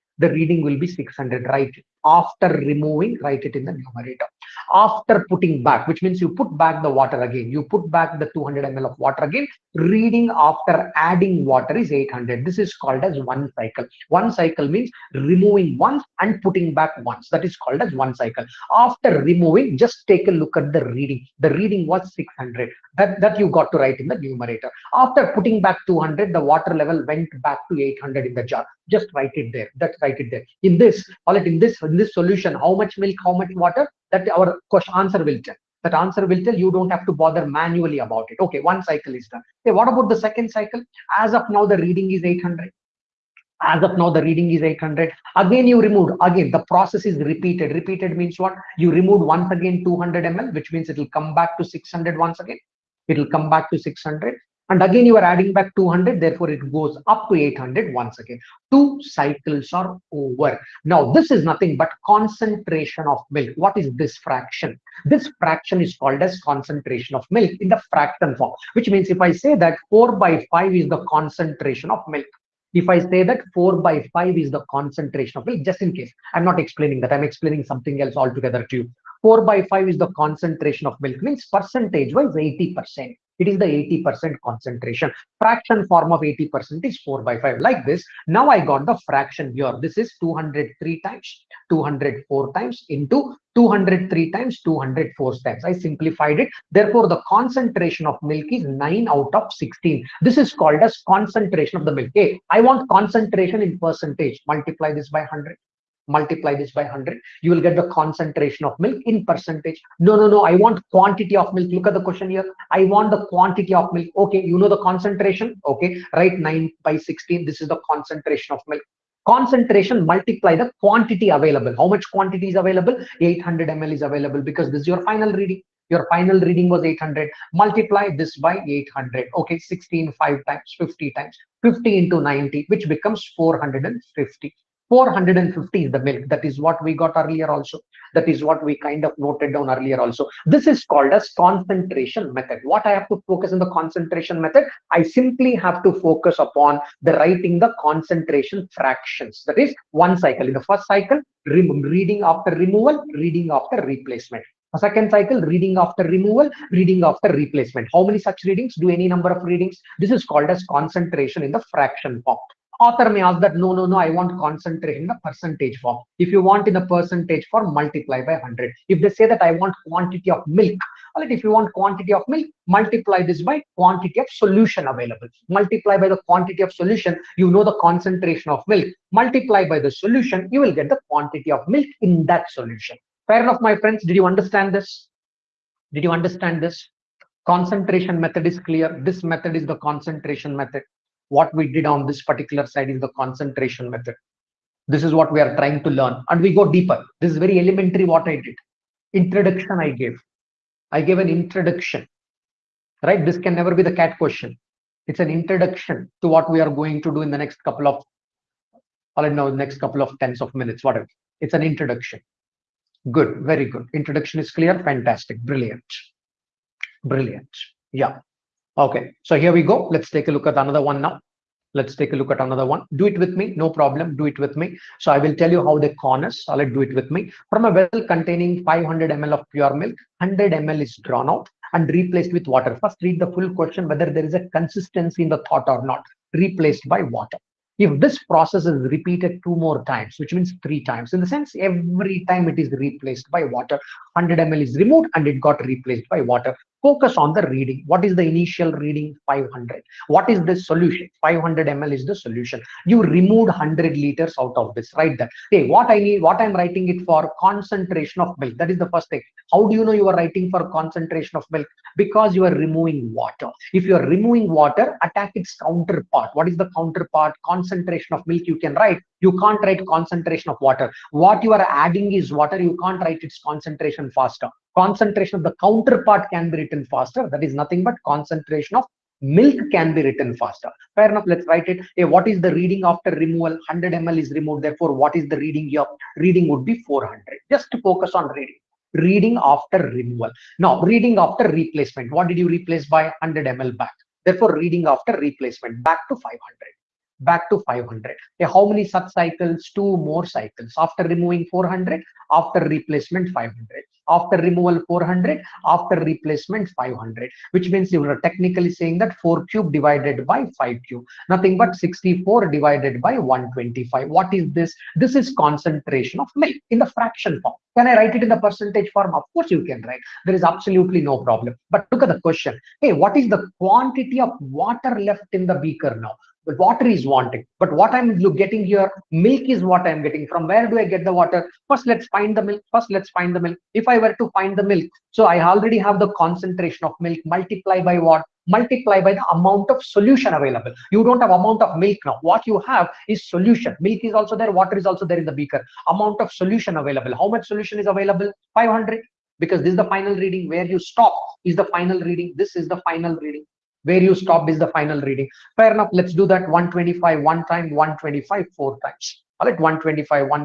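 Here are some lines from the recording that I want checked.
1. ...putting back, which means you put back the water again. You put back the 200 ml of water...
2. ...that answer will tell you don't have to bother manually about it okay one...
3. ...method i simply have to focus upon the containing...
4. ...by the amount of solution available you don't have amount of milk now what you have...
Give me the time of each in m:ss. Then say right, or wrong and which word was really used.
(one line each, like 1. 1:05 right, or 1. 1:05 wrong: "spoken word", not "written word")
1. 0:05 right
2. 0:35 right
3. 2:24 wrong: "writing", not "containing"
4. 5:39 right.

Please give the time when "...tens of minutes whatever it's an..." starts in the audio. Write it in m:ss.
3:30.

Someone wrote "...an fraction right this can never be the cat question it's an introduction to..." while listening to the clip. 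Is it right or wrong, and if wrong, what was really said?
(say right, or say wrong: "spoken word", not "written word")
wrong: "introduction", not "fraction".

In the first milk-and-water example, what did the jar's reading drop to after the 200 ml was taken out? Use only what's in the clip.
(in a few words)
600.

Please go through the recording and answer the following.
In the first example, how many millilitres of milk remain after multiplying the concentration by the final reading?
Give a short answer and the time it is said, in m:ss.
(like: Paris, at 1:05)
450, at 2:14.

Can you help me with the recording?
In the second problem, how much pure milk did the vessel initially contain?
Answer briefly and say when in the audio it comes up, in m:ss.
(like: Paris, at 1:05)
500 ml, at 3:48.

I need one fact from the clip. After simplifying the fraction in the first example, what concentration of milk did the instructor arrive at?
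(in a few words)
9/16.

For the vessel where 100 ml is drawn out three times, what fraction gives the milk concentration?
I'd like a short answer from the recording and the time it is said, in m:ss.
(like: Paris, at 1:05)
64/125, at 5:11.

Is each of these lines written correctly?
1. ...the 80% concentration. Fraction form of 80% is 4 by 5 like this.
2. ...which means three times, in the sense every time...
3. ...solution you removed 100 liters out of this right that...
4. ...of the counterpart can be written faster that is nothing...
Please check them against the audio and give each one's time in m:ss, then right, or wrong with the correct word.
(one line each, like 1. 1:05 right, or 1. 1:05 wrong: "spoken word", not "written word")
1. 1:23 right
2. 4:00 right
3. 4:12 right
4. 4:35 right.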